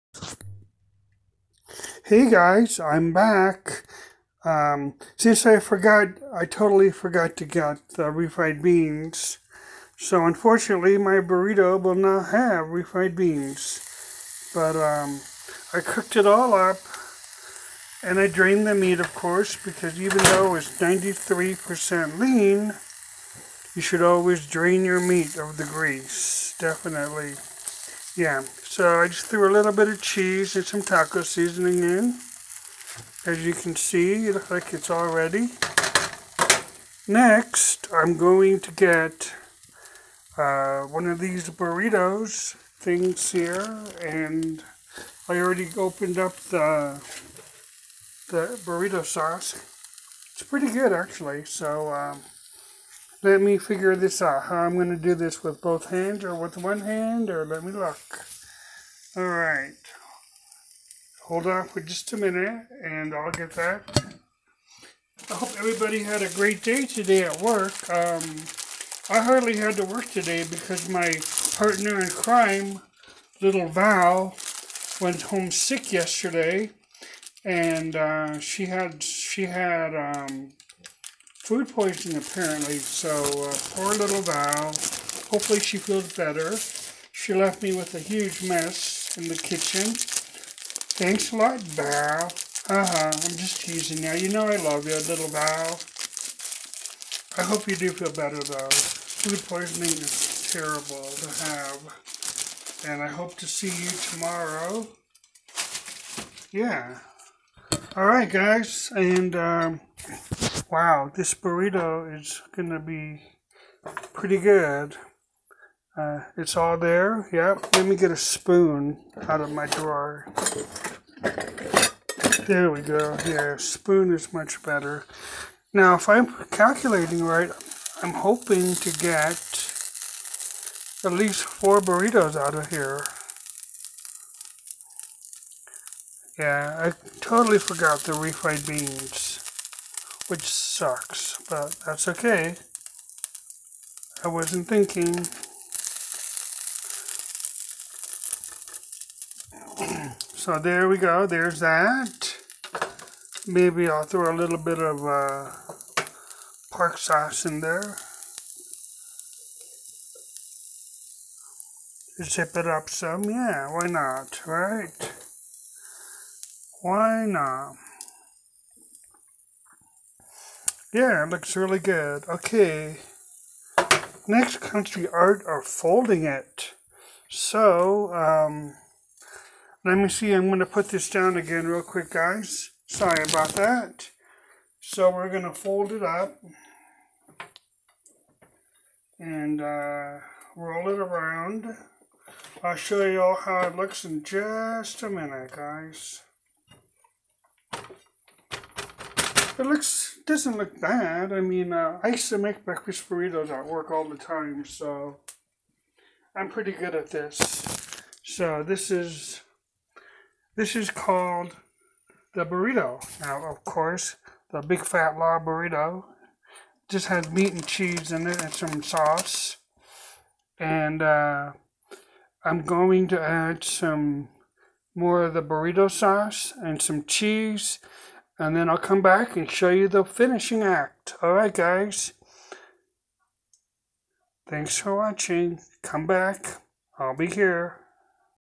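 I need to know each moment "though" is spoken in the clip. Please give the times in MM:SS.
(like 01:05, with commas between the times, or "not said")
00:20, 01:38.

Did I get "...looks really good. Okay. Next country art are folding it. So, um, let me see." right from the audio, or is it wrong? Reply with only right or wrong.
right.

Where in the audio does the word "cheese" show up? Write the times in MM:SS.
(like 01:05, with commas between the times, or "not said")
00:30, 03:37, 03:47.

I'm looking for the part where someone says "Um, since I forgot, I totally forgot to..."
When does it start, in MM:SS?
00:04.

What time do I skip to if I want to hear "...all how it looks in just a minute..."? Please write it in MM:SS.
03:13.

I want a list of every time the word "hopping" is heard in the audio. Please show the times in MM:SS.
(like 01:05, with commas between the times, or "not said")
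not said.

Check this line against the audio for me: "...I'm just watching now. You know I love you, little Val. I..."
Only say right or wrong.
wrong.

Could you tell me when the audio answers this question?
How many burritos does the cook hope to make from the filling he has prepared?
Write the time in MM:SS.
02:11.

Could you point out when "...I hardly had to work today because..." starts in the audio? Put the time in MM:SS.
01:09.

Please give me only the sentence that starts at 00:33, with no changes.
As you can see, it looks like it's all ready.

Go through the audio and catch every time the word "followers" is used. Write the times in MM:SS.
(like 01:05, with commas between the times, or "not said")
not said.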